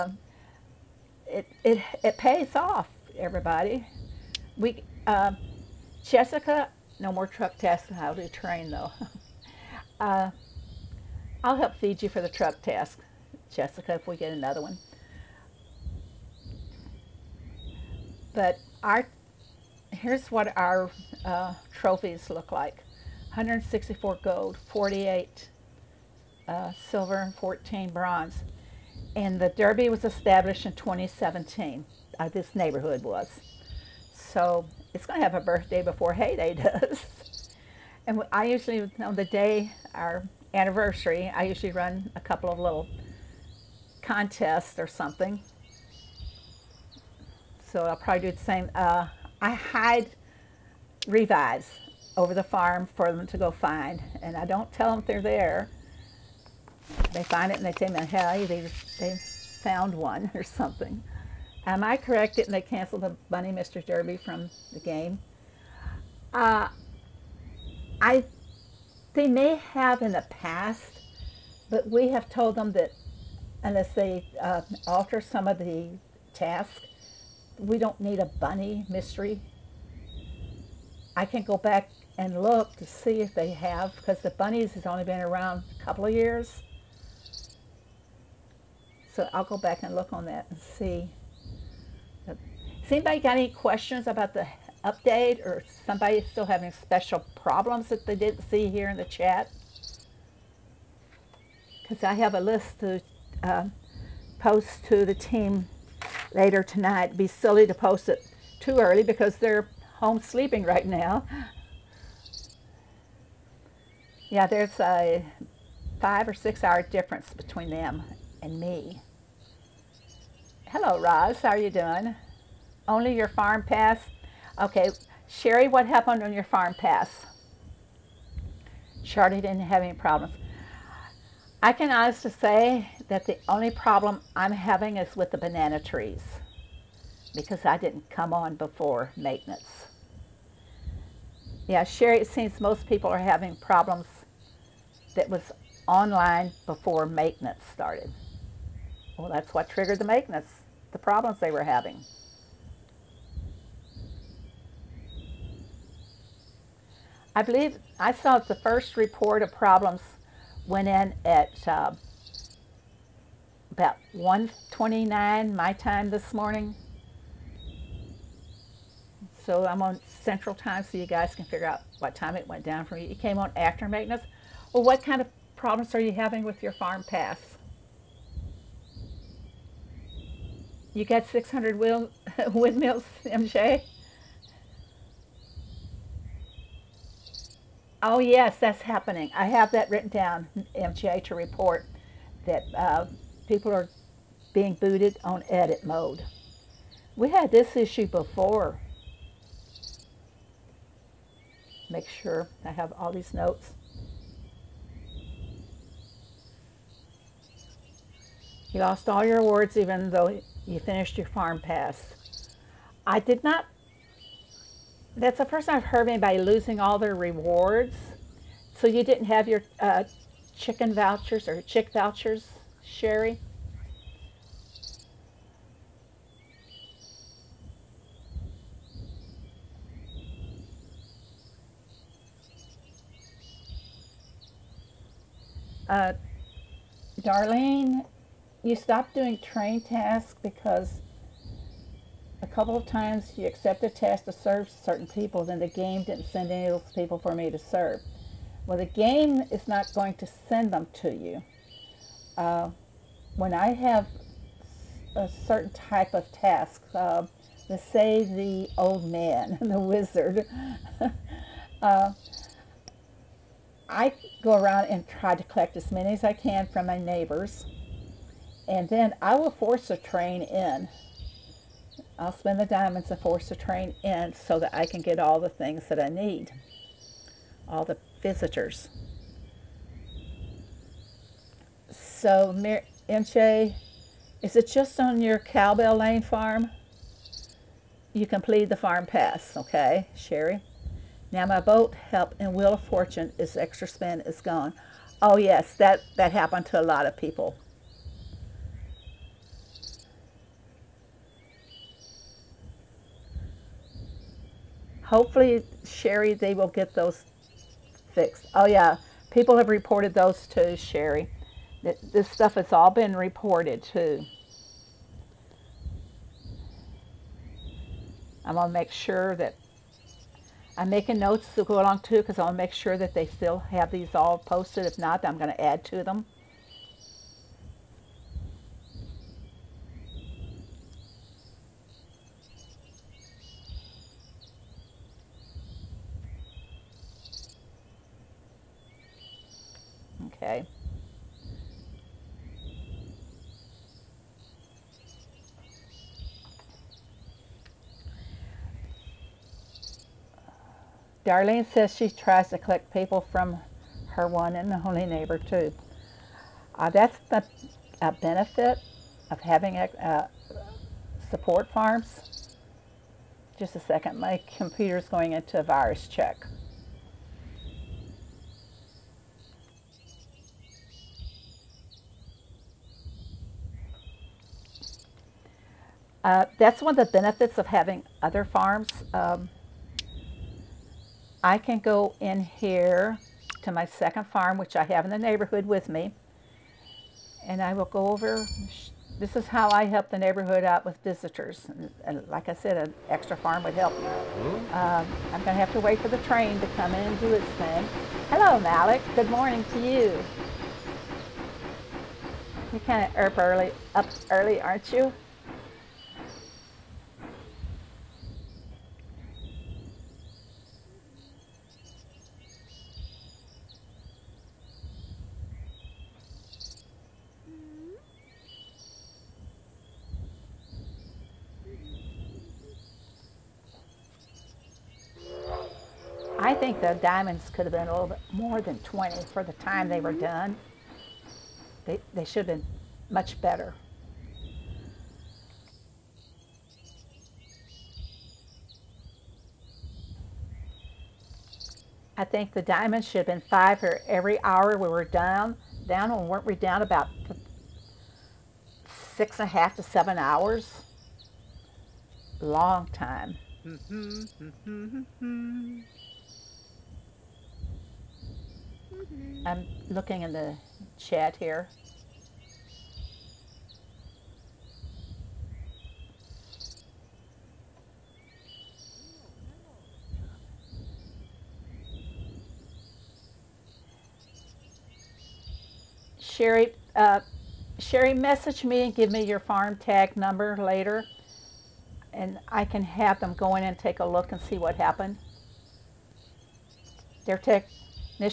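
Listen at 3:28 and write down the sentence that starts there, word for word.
You lost all your awards even though you finished your farm pass.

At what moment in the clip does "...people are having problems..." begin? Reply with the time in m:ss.
2:22.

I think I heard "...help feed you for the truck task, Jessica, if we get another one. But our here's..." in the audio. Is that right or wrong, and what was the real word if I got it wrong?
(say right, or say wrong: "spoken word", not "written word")
right.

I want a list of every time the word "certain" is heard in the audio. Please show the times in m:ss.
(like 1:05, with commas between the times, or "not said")
4:04, 4:15.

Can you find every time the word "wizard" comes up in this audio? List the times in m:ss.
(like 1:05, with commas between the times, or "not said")
4:19.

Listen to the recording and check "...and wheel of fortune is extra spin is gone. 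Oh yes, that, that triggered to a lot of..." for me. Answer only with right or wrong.
wrong.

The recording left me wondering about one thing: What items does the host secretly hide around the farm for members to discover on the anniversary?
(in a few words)
revives.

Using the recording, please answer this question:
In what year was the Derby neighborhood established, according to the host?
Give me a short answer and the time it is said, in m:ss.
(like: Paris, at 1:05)
2017, at 0:30.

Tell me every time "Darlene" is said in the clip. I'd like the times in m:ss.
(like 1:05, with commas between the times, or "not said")
3:57, 5:51.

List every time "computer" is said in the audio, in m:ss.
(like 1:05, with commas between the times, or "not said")
6:04.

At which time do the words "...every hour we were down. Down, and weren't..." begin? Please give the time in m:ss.
7:24.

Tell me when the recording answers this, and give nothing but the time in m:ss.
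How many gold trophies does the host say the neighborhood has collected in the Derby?
0:23.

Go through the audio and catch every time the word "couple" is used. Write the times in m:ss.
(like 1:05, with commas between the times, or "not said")
0:42, 1:25, 4:02.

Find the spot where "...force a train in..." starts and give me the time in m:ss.
4:29.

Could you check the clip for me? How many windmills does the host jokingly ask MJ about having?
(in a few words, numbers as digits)
600.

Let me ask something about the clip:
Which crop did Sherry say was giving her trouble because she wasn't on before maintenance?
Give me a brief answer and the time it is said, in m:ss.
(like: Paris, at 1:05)
banana trees, at 2:15.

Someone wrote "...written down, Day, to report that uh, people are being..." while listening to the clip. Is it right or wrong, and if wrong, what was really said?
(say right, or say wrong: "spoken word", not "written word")
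wrong: "MGA", not "Day".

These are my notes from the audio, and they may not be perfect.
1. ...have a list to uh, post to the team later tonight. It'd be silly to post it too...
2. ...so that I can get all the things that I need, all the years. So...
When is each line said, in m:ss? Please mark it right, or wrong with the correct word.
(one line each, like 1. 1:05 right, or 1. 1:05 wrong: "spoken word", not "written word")
1. 1:42 right
2. 4:34 wrong: "visitors", not "years".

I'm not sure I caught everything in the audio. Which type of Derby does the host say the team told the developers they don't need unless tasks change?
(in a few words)
Bunny mystery.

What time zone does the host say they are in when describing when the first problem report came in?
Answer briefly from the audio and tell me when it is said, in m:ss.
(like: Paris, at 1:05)
Central Time, at 2:50.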